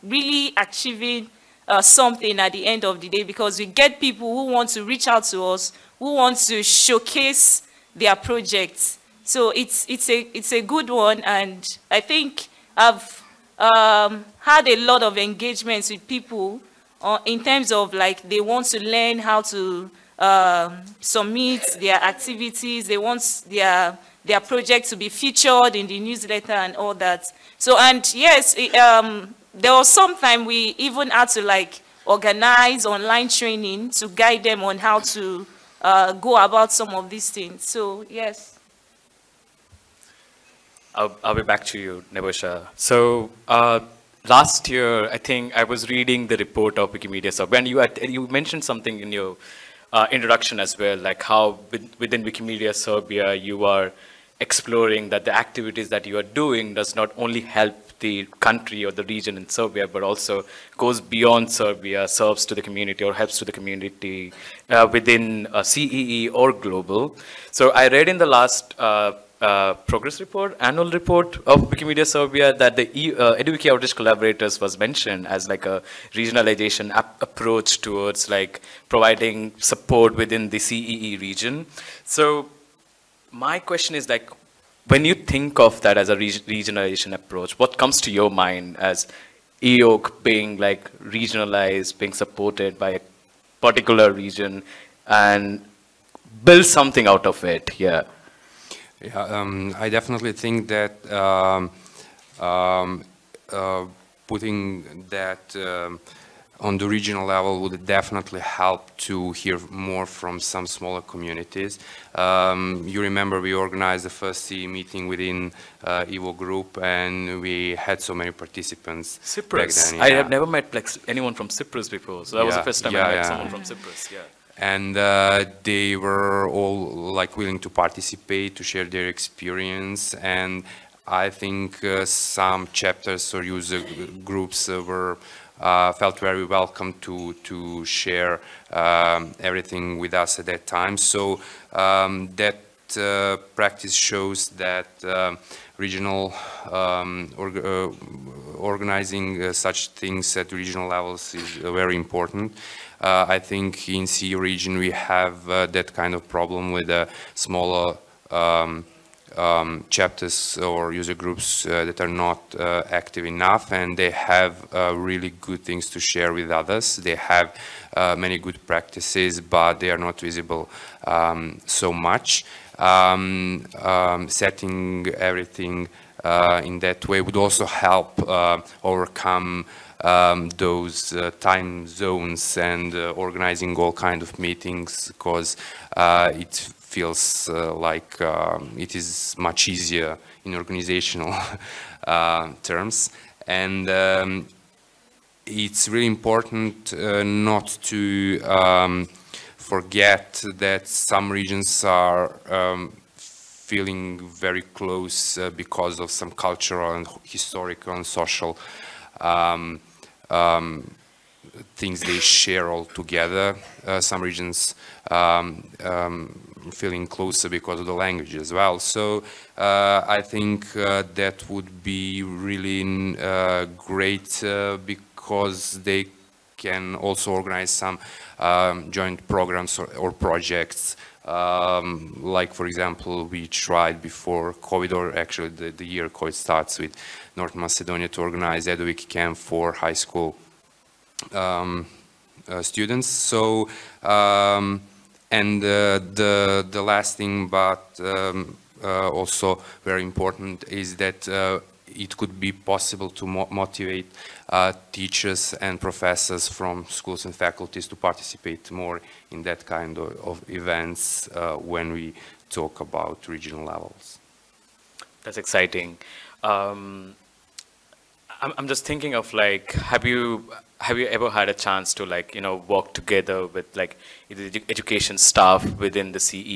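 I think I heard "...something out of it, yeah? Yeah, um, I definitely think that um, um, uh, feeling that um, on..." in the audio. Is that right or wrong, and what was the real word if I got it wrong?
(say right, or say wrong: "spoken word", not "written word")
wrong: "putting", not "feeling".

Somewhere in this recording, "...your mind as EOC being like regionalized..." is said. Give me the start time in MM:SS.
01:28.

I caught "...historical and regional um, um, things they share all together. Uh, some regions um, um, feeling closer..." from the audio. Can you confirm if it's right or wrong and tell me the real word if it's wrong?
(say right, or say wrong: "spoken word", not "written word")
wrong: "social", not "regional".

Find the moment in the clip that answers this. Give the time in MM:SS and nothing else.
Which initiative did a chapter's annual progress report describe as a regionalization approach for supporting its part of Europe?
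01:13.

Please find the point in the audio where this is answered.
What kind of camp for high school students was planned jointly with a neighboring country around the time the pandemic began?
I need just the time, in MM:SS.
03:58.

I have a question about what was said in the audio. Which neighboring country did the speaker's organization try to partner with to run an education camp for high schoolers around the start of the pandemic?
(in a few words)
North Macedonia.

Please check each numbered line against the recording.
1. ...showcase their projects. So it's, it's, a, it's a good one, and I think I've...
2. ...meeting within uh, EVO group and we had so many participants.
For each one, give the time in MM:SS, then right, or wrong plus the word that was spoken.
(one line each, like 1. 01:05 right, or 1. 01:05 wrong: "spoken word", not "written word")
1. 00:06 right
2. 01:54 right.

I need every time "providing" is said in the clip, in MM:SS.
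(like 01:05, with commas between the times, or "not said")
01:18.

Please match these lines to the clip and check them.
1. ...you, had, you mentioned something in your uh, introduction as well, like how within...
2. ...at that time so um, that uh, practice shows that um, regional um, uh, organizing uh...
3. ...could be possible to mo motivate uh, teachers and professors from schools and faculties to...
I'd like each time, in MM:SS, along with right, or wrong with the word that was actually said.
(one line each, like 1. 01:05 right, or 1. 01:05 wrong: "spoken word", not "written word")
1. 00:47 right
2. 02:20 right
3. 04:12 right.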